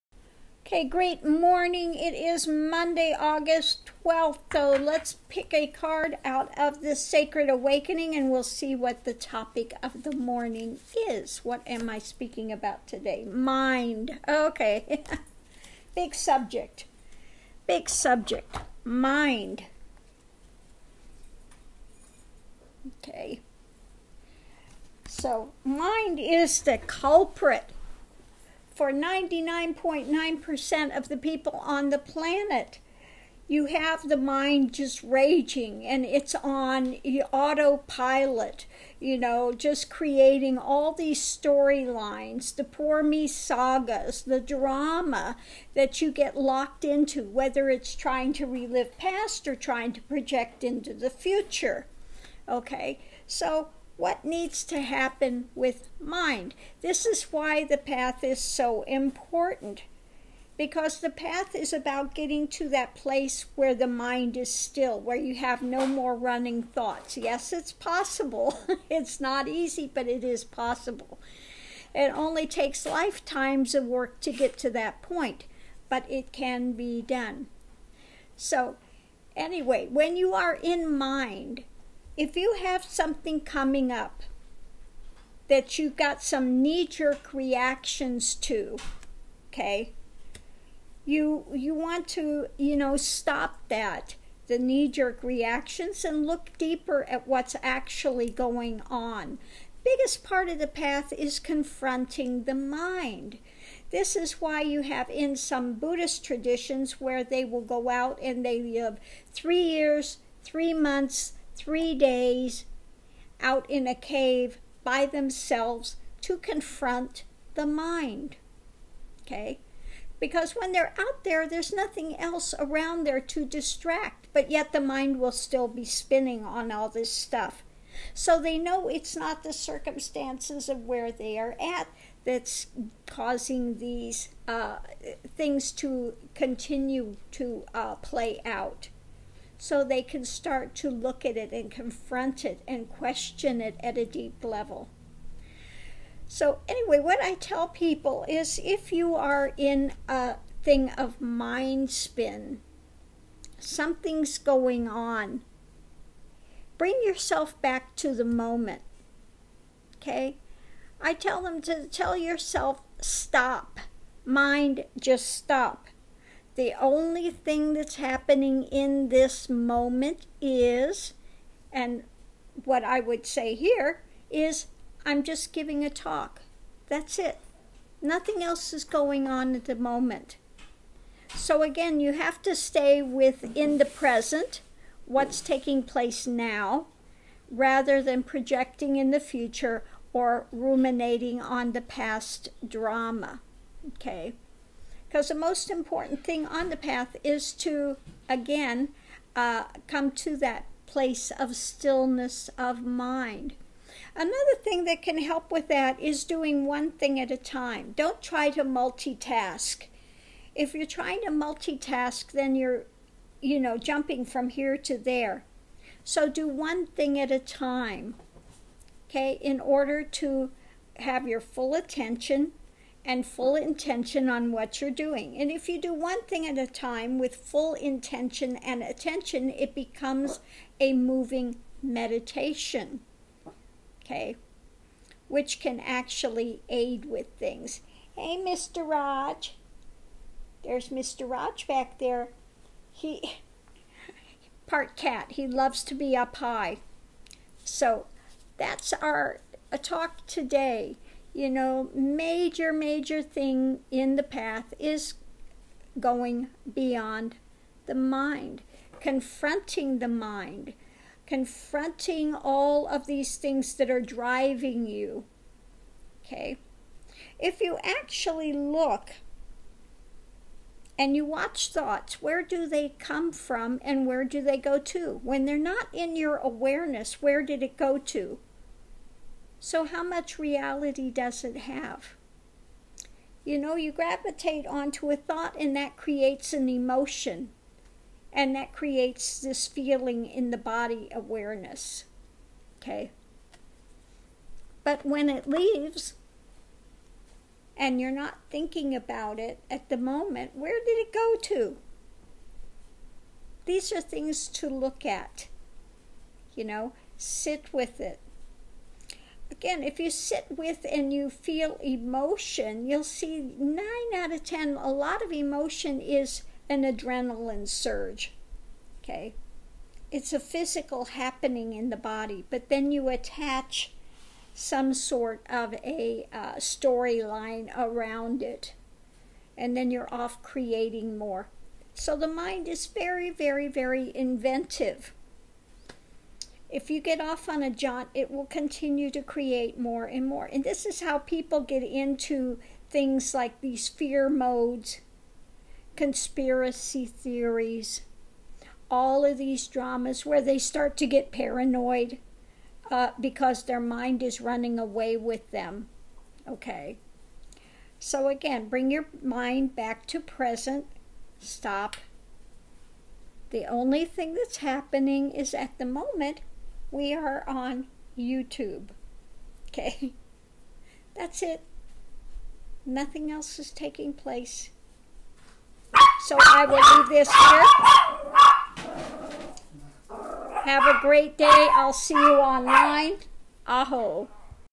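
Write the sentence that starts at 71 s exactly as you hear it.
It only takes lifetimes of work to get to that point, but it can be done.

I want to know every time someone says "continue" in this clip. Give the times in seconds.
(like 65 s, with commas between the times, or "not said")
136 s, 338 s.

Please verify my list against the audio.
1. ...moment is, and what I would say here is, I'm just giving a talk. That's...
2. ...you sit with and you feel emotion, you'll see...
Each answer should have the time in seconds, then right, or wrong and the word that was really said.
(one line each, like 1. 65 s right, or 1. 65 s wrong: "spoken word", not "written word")
1. 169 s right
2. 309 s right.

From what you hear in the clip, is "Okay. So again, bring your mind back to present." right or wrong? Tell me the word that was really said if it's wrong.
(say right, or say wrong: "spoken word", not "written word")
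right.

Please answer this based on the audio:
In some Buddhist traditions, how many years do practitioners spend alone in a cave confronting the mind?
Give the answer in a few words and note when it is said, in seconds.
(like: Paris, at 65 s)
3, at 109 s.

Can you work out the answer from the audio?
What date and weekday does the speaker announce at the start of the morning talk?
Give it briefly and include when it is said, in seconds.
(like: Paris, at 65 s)
Monday, August 12th, at 2 s.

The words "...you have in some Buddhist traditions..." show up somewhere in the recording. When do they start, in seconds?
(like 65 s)
104 s.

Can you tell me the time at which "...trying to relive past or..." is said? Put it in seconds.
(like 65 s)
47 s.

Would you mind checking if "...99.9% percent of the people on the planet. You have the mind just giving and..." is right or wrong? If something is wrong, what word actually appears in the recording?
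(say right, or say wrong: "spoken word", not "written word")
wrong: "raging", not "giving".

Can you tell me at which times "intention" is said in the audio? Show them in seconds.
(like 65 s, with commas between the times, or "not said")
223 s, 227 s.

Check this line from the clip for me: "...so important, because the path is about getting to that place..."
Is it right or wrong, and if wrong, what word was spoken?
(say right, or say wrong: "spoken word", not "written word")
right.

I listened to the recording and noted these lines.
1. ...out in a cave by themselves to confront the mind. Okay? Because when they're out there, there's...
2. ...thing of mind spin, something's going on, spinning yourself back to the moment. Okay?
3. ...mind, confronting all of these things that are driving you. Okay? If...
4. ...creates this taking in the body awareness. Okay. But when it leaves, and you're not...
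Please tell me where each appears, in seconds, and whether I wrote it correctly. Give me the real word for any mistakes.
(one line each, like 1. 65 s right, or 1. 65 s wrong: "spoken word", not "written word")
1. 113 s right
2. 150 s wrong: "bring", not "spinning"
3. 260 s right
4. 288 s wrong: "feeling", not "taking".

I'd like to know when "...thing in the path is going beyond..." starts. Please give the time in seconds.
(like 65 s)
253 s.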